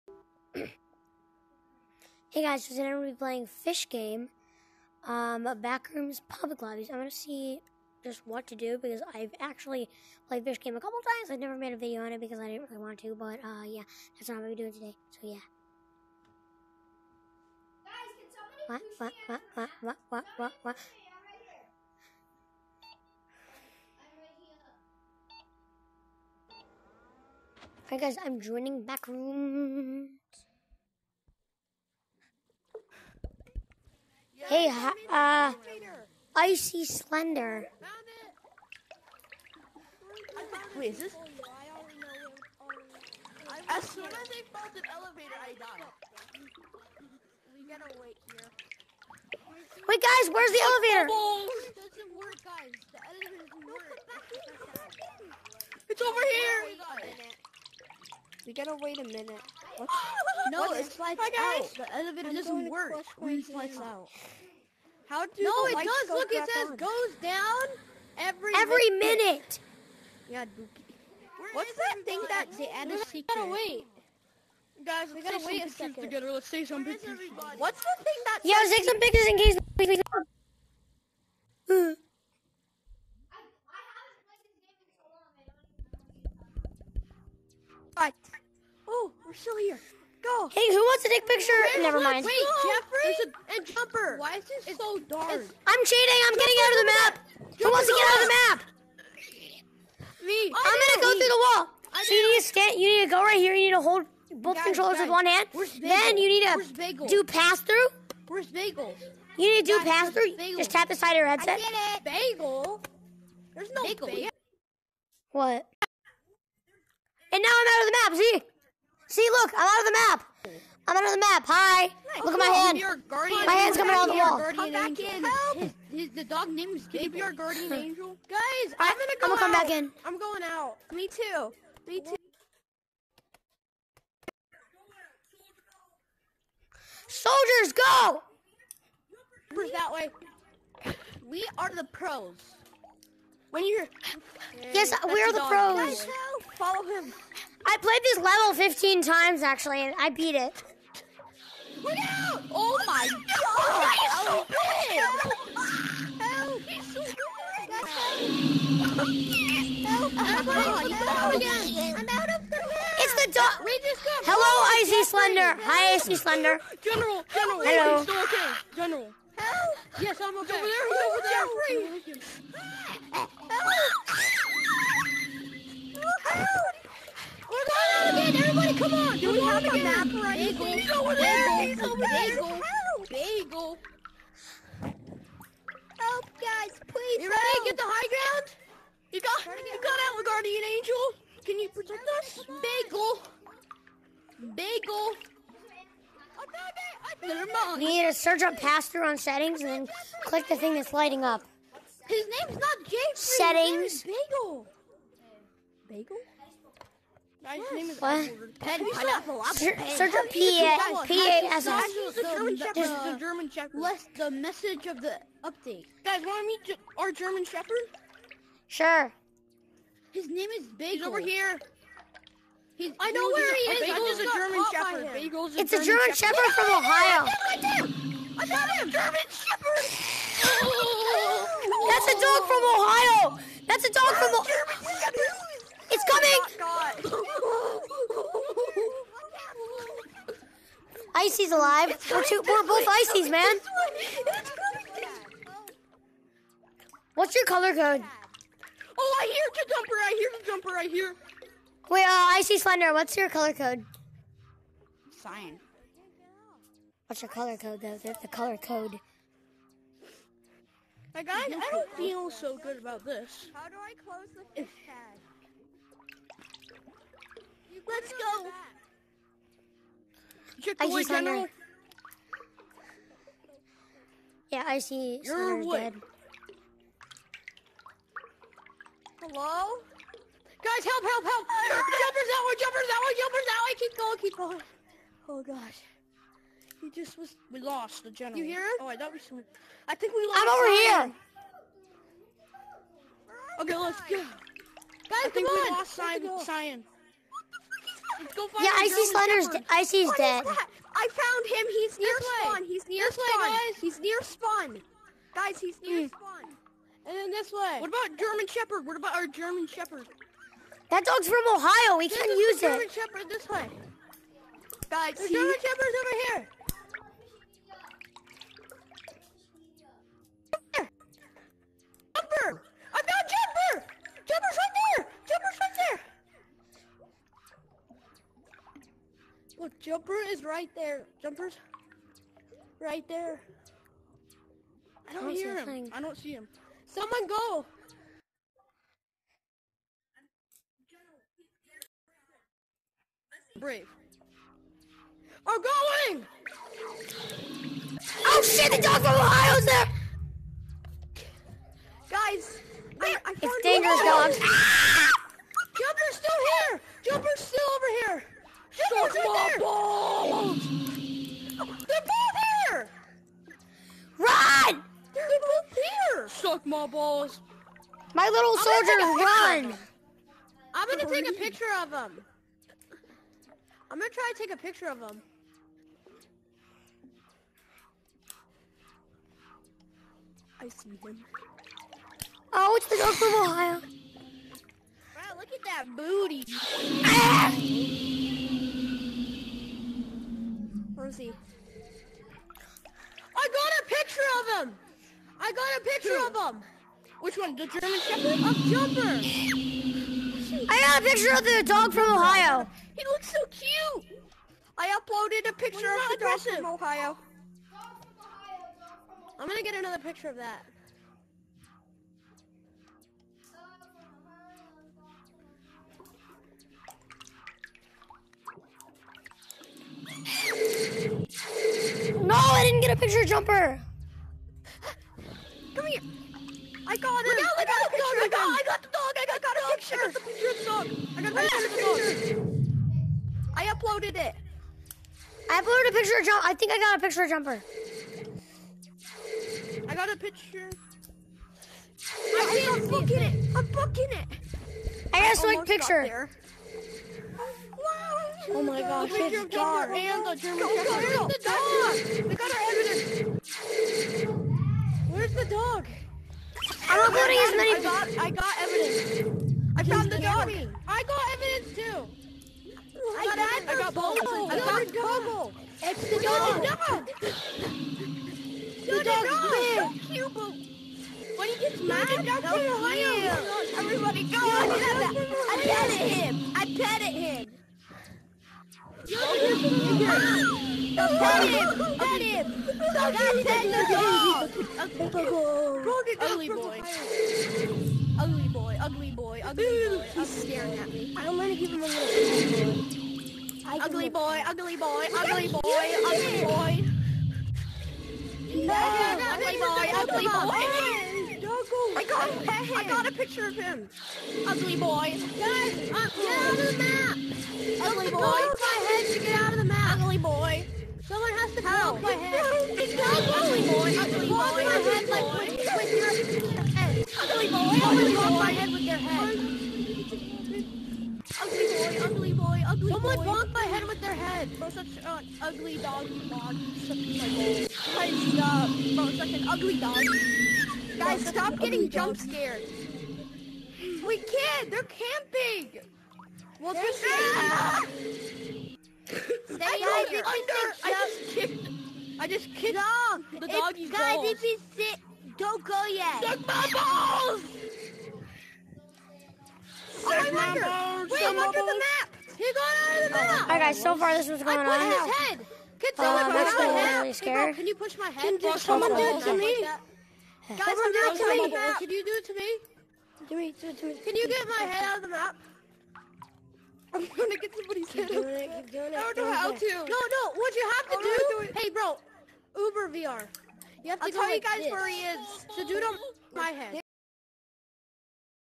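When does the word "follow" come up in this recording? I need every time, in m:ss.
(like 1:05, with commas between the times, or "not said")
2:26.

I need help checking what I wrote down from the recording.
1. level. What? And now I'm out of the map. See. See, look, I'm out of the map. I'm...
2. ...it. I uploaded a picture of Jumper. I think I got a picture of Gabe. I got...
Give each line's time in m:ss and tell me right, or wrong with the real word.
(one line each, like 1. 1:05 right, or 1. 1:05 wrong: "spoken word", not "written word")
1. 1:54 wrong: "bagel", not "level"
2. 7:14 wrong: "Jumper", not "Gabe".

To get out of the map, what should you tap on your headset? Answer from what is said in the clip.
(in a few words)
The side.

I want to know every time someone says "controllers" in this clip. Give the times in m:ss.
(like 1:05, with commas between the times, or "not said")
1:44.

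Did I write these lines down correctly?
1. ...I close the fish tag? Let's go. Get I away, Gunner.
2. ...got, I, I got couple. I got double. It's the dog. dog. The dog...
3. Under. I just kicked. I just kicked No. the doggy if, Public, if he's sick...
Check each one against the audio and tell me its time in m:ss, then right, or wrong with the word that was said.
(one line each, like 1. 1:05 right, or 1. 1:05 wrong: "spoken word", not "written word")
1. 4:23 right
2. 7:43 wrong: "bubble", not "couple"
3. 9:00 wrong: "Guys", not "Public".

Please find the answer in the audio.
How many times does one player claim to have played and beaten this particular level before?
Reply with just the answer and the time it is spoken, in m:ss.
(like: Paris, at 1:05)
15, at 2:28.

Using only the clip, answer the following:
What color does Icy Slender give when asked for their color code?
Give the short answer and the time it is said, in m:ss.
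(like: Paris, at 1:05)
Cyan, at 4:15.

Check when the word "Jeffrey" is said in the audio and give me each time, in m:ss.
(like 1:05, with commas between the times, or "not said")
1:32.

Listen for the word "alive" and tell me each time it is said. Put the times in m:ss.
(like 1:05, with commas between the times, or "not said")
4:01.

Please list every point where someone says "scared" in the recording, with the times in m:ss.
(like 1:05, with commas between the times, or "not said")
8:52, 9:17.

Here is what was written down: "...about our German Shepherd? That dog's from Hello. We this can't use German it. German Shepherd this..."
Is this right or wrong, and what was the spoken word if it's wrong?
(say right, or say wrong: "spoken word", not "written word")
wrong: "Ohio", not "Hello".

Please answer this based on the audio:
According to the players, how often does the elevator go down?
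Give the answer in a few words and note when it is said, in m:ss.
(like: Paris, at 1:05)
Every minute, at 1:08.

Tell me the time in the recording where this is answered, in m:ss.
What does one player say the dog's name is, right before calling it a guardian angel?
2:06.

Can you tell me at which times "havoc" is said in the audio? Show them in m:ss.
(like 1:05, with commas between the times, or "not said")
not said.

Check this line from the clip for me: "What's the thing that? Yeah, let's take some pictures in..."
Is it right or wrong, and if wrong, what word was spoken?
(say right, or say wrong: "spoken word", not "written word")
right.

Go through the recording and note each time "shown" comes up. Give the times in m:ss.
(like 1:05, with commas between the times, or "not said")
not said.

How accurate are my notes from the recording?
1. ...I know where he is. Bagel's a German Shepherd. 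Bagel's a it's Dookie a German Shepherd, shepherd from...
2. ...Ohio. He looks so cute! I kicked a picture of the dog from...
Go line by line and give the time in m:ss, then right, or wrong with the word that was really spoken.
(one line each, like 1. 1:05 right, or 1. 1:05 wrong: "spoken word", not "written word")
1. 3:42 wrong: "German", not "Dookie"
2. 6:42 wrong: "uploaded", not "kicked".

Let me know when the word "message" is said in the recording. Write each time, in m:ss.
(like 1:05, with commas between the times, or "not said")
3:34.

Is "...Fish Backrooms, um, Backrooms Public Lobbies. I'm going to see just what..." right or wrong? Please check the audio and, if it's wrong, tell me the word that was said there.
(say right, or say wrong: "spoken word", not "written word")
wrong: "Game", not "Backrooms".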